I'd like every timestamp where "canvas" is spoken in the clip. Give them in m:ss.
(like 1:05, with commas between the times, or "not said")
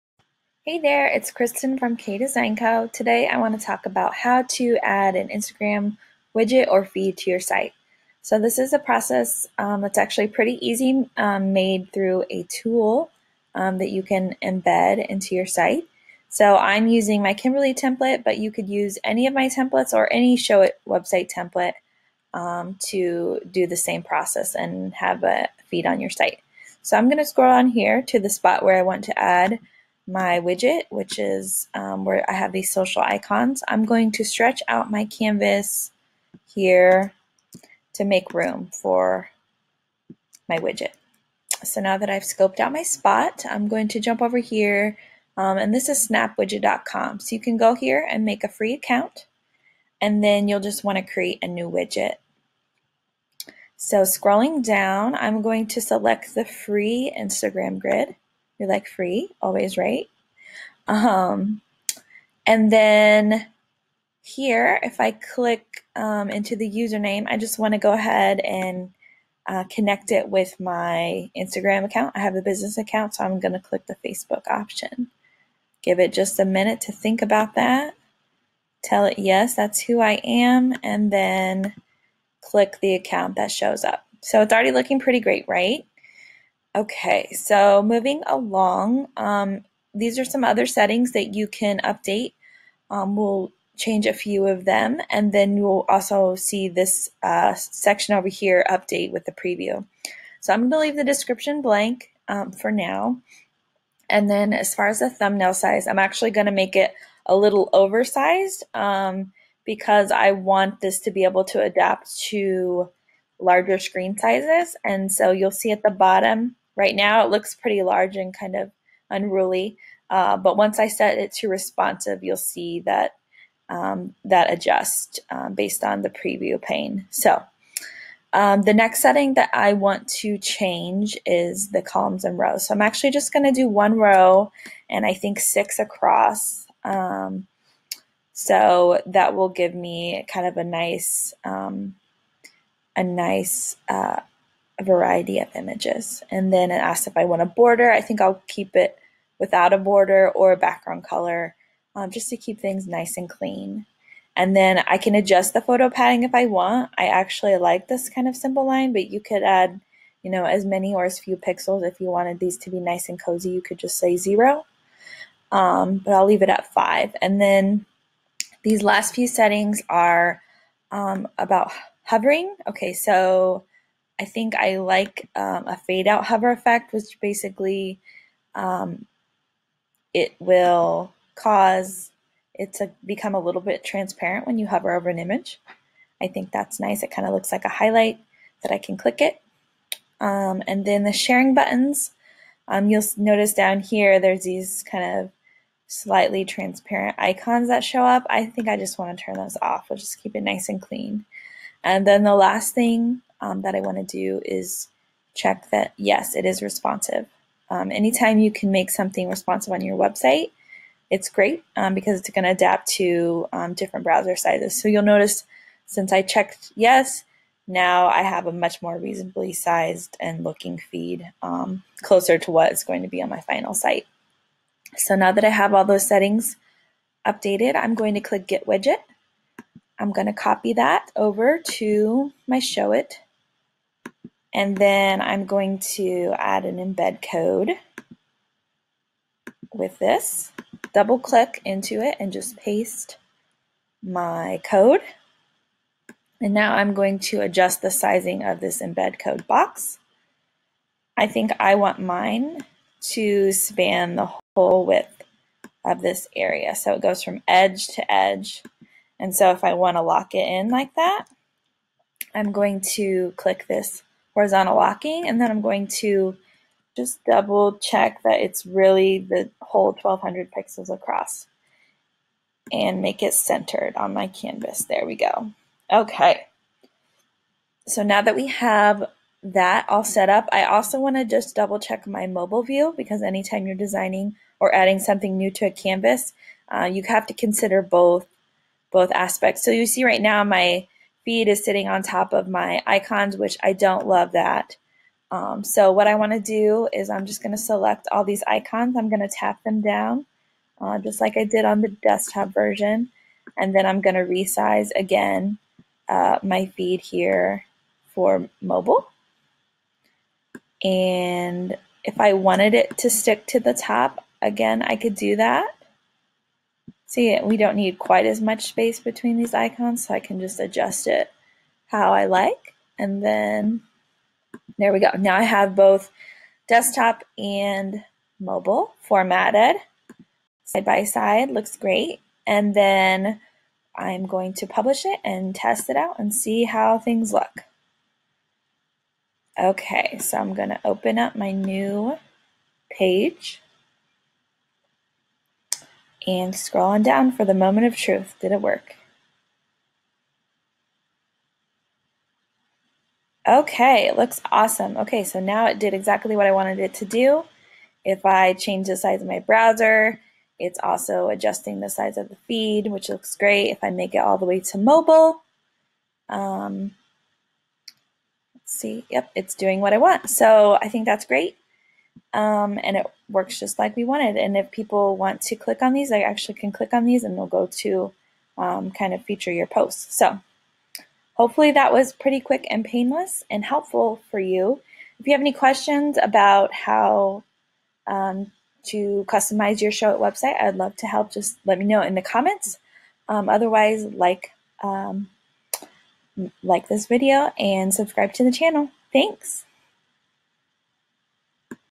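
0:35, 4:34, 4:45.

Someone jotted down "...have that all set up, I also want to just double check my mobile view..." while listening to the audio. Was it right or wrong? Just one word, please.
right.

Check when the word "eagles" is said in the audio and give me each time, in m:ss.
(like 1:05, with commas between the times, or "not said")
not said.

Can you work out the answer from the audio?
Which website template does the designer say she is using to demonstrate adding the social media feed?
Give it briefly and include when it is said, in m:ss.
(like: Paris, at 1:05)
Kimberly, at 0:17.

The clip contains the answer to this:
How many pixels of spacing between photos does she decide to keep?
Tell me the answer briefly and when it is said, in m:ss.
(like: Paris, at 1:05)
5, at 2:46.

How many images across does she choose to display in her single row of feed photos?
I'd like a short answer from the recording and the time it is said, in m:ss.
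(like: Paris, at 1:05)
6, at 2:15.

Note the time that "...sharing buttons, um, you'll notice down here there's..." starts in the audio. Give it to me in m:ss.
3:11.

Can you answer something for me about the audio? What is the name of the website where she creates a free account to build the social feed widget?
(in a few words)
snapwidget.com.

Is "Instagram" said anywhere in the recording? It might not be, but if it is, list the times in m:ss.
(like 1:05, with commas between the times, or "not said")
0:05, 0:57, 1:11.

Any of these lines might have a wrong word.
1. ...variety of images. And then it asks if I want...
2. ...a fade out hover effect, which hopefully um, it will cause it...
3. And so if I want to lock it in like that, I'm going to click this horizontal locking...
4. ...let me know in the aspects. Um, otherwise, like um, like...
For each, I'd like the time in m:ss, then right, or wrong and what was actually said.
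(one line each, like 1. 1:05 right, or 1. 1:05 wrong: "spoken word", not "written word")
1. 2:24 right
2. 2:55 wrong: "basically", not "hopefully"
3. 4:19 right
4. 6:31 wrong: "comments", not "aspects".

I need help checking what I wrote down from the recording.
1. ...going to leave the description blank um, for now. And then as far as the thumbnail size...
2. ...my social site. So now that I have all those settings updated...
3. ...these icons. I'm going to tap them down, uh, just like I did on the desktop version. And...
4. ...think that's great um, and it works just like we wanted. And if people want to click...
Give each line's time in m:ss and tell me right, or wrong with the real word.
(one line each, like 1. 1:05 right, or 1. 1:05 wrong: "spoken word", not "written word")
1. 1:40 right
2. 3:43 wrong: "final", not "social"
3. 4:58 right
4. 6:10 right.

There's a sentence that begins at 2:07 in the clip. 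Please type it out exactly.
So um, the next setting that I want to change is the columns and rows.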